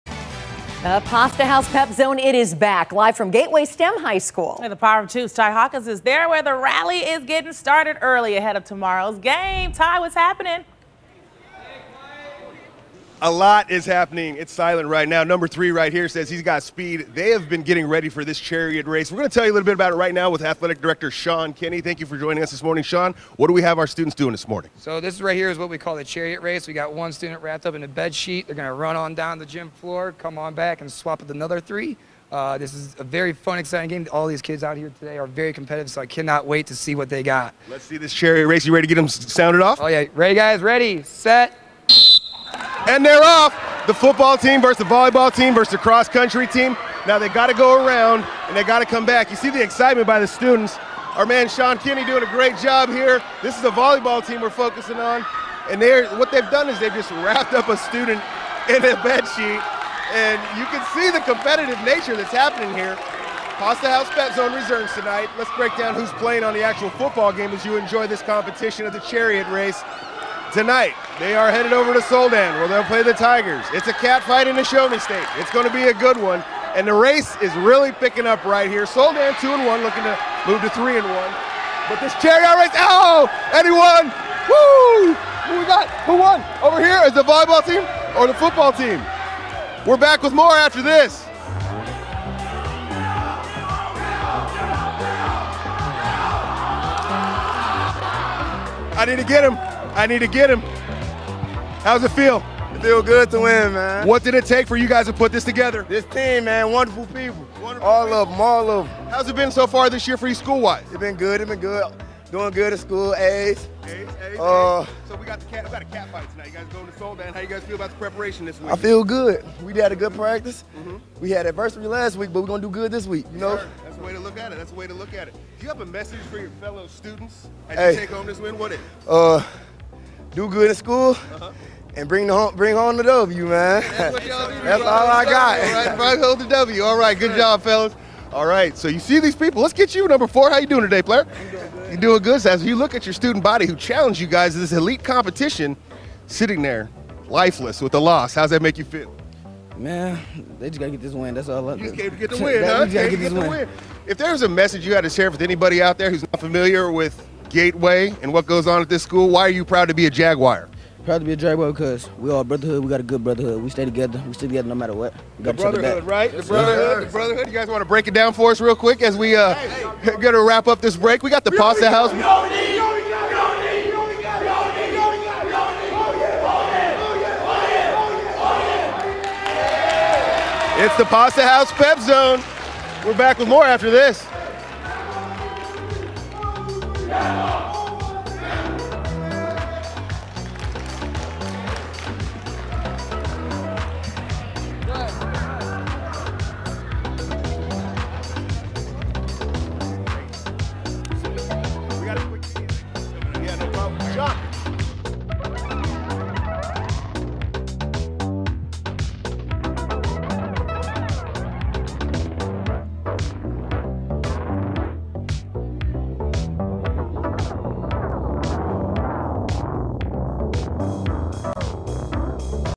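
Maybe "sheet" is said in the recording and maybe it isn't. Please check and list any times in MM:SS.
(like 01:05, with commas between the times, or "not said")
00:28, 00:59.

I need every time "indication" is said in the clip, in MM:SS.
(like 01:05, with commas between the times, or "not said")
not said.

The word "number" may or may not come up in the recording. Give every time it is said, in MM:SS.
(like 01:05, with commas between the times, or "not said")
00:15, 02:20.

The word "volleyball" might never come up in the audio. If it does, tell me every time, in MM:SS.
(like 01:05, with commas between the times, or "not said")
00:44, 00:53, 01:27.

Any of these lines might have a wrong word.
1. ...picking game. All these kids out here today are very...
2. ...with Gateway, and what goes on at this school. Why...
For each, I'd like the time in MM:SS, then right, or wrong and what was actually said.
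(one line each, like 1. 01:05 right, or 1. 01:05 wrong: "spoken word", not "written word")
1. 00:33 wrong: "exciting", not "picking"
2. 02:36 right.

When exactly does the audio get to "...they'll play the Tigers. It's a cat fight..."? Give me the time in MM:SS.
01:12.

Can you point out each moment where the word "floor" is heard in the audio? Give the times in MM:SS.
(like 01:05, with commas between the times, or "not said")
00:29.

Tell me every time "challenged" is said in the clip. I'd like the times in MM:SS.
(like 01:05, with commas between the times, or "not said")
02:23.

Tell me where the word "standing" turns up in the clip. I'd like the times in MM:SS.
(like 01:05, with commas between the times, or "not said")
not said.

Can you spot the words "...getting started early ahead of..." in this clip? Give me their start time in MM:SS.
00:07.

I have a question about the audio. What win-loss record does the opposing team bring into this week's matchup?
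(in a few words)
2 and 1.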